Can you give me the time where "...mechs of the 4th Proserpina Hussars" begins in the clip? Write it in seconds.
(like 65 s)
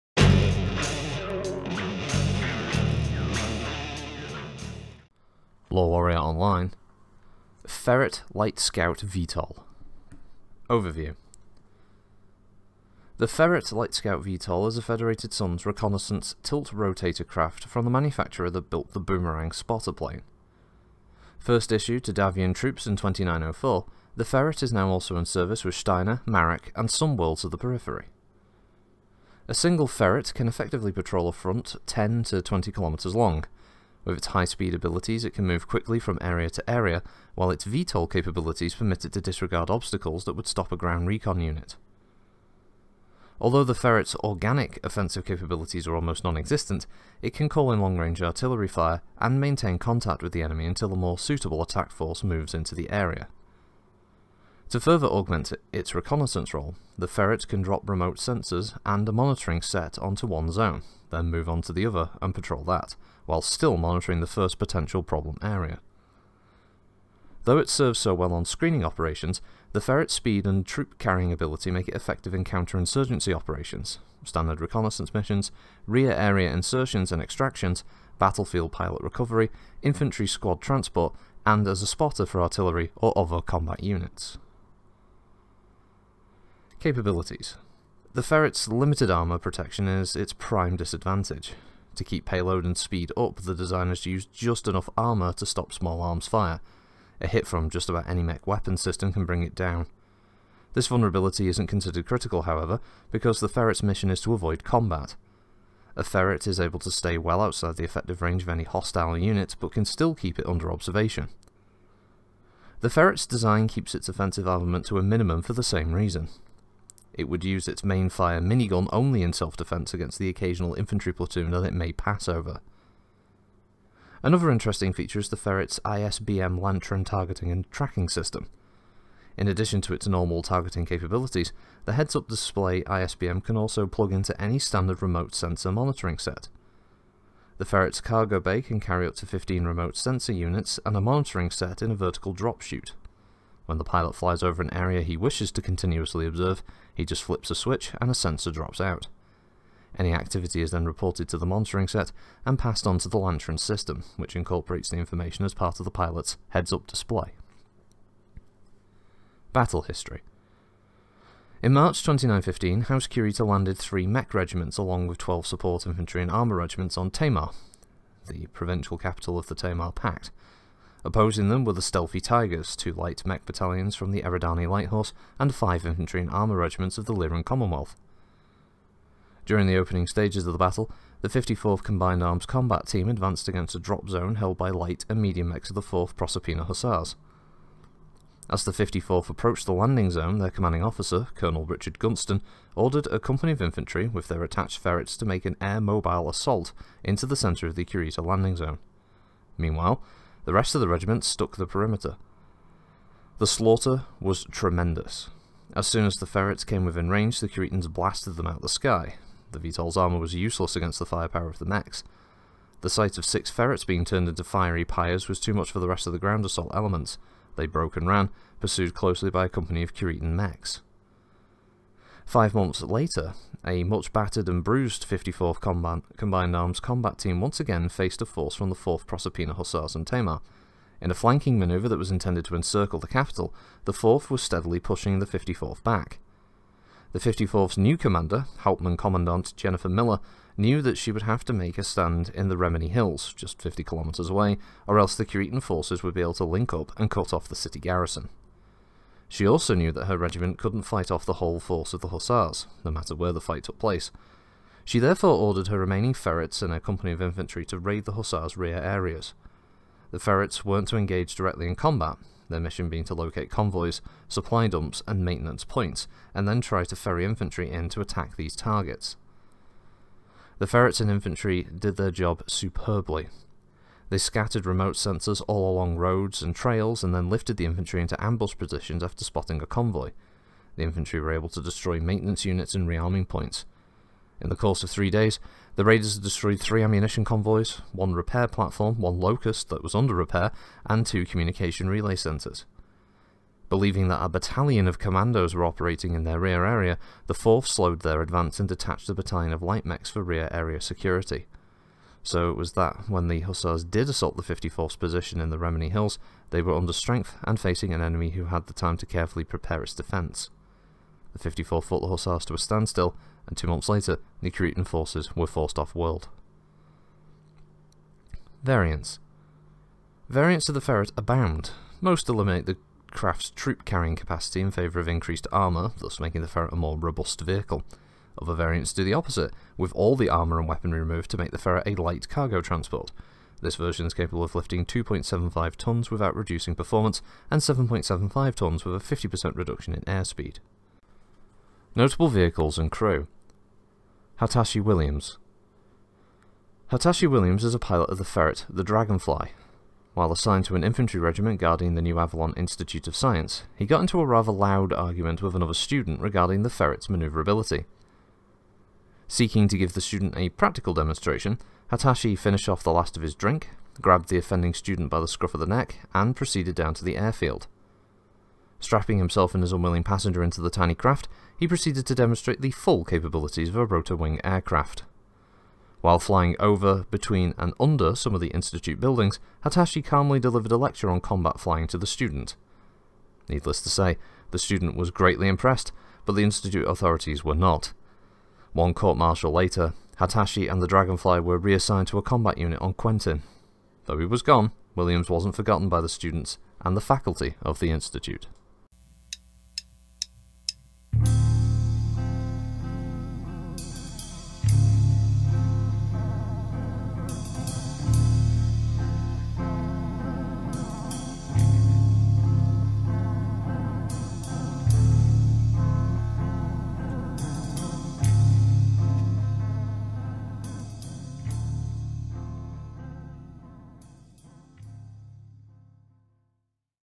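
185 s.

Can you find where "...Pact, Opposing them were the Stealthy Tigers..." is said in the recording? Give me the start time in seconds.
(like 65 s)
169 s.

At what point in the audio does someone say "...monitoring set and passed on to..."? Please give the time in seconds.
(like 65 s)
151 s.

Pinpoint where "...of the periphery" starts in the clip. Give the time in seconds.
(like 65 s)
27 s.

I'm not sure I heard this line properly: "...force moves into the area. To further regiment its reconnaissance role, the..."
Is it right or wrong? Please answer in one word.
wrong.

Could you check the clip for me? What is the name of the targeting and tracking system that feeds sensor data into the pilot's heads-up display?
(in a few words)
ISBM Lantern.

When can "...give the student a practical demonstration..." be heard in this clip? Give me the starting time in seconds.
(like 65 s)
359 s.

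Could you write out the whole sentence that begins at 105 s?
A ferret is able to stay well outside the effective range of any hostile unit, but can still keep it under observation.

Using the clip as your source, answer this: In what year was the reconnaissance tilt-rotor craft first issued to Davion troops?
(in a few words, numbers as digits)
2904.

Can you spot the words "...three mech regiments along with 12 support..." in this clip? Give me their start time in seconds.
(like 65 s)
163 s.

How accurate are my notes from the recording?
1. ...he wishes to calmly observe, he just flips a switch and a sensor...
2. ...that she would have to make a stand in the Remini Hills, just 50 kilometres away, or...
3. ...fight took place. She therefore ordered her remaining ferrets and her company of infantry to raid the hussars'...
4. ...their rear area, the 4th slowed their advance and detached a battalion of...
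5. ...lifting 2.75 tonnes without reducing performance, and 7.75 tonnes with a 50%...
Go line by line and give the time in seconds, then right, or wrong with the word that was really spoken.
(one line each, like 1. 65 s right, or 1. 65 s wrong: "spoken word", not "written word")
1. 145 s wrong: "continuously", not "calmly"
2. 240 s right
3. 253 s right
4. 296 s right
5. 334 s right.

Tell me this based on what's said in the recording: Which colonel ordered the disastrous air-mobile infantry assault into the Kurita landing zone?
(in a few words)
Richard Gunston.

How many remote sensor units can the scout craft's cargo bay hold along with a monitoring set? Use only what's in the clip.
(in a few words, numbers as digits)
15.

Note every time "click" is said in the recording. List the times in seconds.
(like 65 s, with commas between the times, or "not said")
not said.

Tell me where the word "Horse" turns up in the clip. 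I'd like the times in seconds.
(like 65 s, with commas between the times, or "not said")
174 s.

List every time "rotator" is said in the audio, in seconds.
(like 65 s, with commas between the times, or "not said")
16 s.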